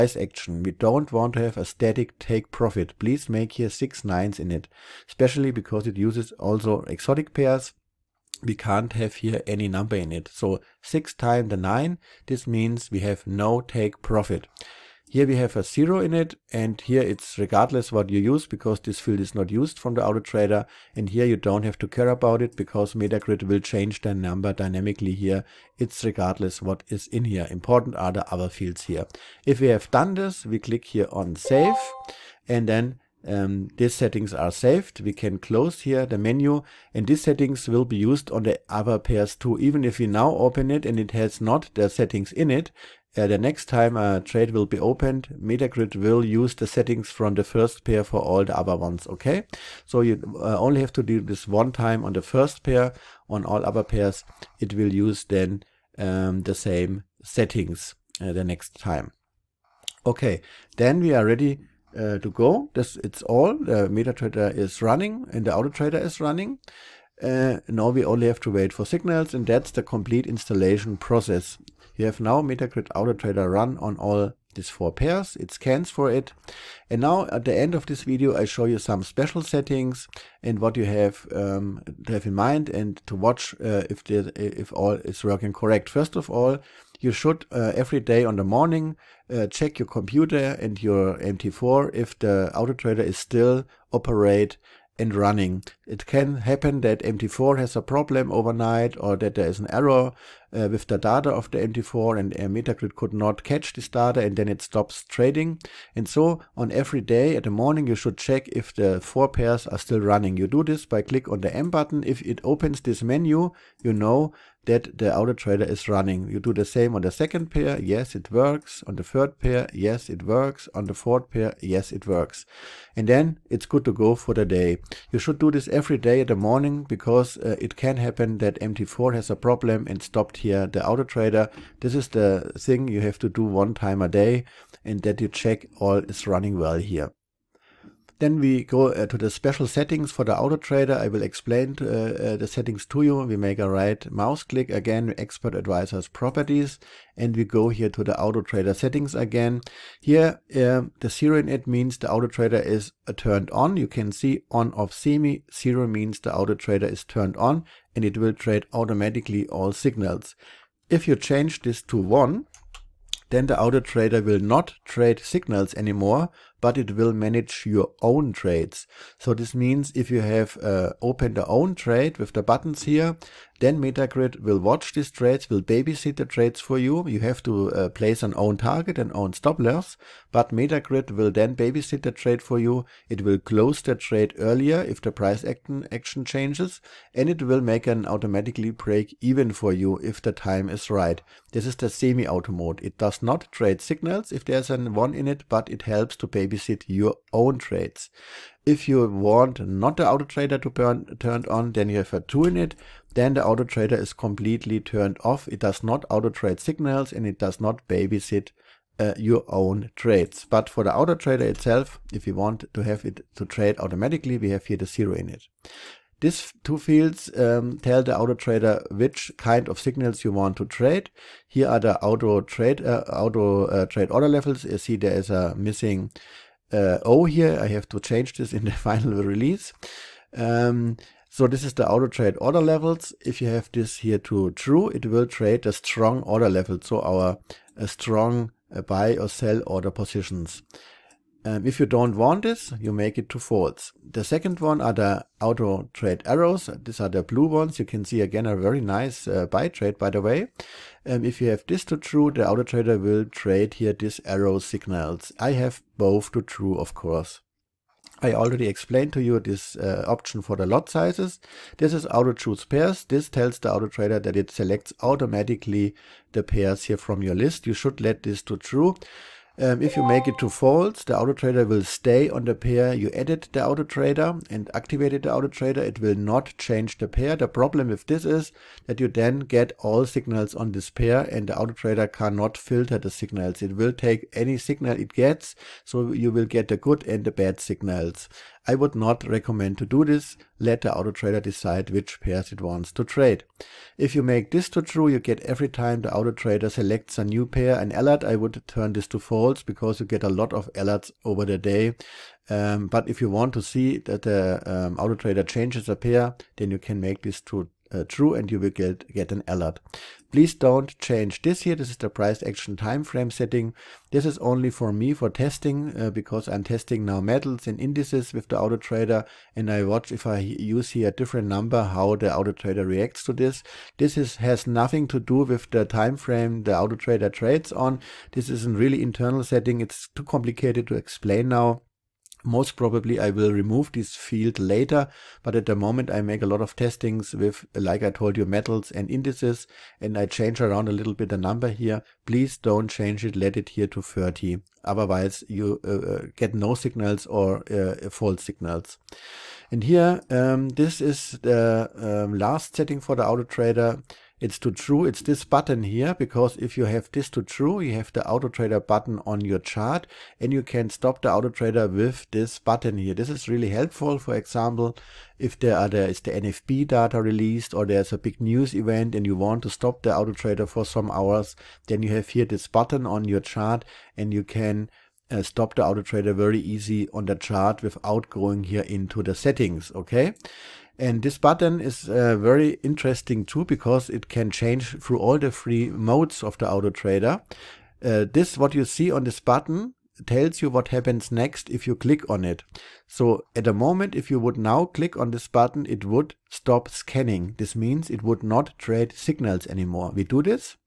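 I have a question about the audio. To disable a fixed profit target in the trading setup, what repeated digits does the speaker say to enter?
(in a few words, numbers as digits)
6 nines.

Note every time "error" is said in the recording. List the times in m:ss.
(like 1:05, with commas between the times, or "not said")
1:39.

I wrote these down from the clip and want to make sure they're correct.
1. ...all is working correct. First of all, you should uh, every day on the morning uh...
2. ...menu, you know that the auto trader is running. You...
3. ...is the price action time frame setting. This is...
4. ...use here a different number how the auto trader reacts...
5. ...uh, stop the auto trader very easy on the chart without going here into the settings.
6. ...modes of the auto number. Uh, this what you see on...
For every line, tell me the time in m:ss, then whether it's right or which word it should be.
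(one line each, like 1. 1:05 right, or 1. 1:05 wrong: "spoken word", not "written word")
1. 1:24 right
2. 1:53 right
3. 5:11 right
4. 5:20 right
5. 6:15 right
6. 6:25 wrong: "trader", not "number".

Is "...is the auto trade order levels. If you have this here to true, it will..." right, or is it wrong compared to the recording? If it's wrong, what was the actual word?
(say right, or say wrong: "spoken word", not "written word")
right.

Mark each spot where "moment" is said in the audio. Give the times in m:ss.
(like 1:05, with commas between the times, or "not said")
5:35, 6:33.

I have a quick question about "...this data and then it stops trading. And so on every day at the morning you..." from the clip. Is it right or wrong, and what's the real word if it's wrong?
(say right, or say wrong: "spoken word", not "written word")
right.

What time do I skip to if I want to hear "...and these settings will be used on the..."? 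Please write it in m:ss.
0:36.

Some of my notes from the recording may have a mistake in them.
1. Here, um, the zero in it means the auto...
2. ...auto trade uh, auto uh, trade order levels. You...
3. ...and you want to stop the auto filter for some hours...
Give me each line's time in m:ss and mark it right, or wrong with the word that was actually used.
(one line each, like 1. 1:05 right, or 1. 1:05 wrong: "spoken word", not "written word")
1. 2:30 right
2. 3:42 right
3. 6:09 wrong: "trader", not "filter".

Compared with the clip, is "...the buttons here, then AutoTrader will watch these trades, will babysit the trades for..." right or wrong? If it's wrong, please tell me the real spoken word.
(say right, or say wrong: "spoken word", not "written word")
wrong: "Metagrid", not "AutoTrader".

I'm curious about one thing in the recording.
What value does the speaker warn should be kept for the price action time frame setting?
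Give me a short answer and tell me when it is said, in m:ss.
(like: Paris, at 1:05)
30, at 5:44.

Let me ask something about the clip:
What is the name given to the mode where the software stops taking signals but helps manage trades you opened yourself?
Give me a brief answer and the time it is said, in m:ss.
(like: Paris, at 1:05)
semi-auto mode, at 3:11.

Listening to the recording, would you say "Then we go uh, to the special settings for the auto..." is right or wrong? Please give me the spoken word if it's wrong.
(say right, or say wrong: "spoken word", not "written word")
right.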